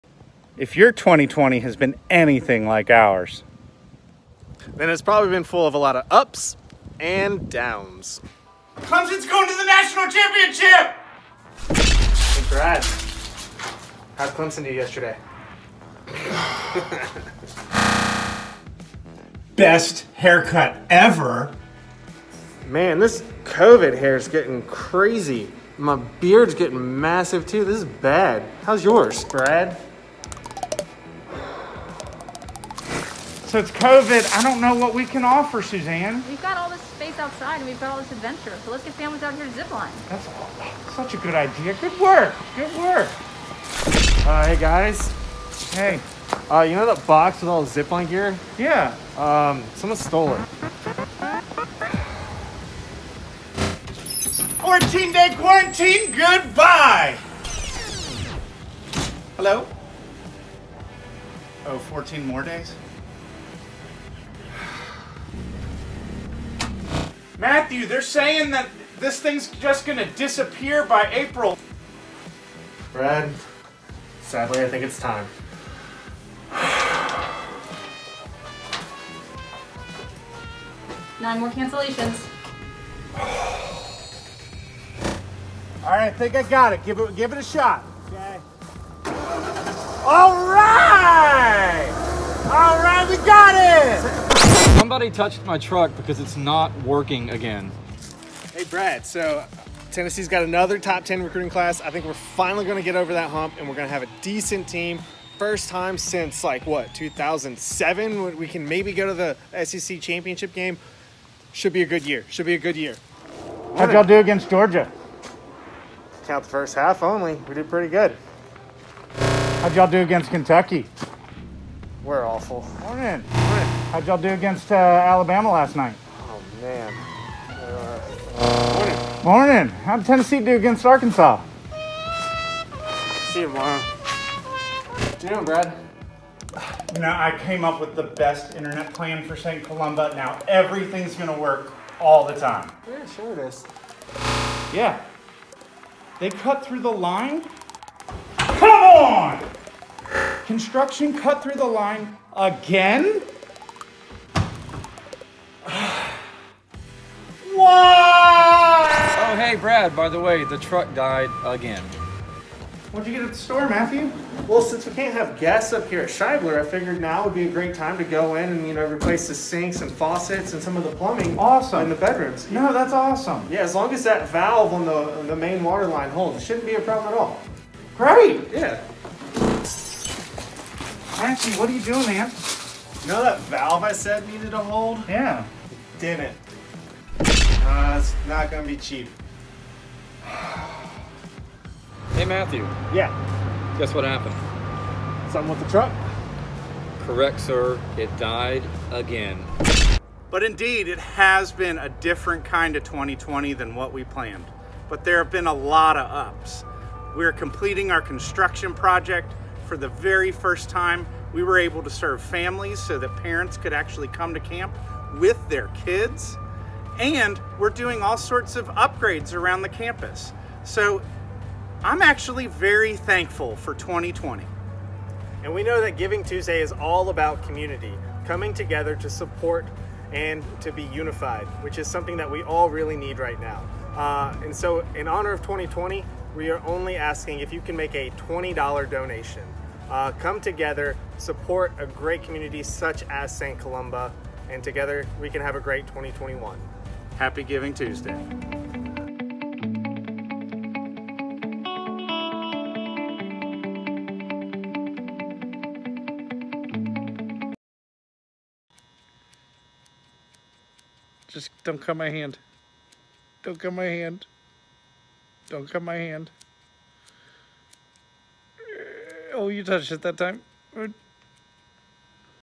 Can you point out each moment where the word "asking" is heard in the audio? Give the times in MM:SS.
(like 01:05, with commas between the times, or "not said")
03:56.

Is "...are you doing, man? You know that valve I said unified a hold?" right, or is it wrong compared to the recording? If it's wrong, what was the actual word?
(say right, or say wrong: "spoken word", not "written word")
wrong: "needed", not "unified".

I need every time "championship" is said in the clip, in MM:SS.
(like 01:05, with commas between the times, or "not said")
00:10, 01:50.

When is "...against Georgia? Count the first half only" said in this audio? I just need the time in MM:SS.
01:54.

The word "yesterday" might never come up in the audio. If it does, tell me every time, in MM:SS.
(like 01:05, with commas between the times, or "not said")
00:14.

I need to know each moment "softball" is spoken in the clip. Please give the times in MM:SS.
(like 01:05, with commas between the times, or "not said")
not said.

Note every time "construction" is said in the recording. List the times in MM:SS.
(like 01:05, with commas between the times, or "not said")
02:30, 03:28.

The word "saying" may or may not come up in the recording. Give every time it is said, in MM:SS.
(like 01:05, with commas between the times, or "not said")
01:08.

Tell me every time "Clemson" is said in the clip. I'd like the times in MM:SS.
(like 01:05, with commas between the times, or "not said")
00:08, 00:14.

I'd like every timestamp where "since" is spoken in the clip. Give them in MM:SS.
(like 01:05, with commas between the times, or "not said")
01:45, 02:44.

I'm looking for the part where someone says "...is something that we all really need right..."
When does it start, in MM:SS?
03:51.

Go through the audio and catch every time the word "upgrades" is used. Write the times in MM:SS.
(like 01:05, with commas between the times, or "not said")
03:38.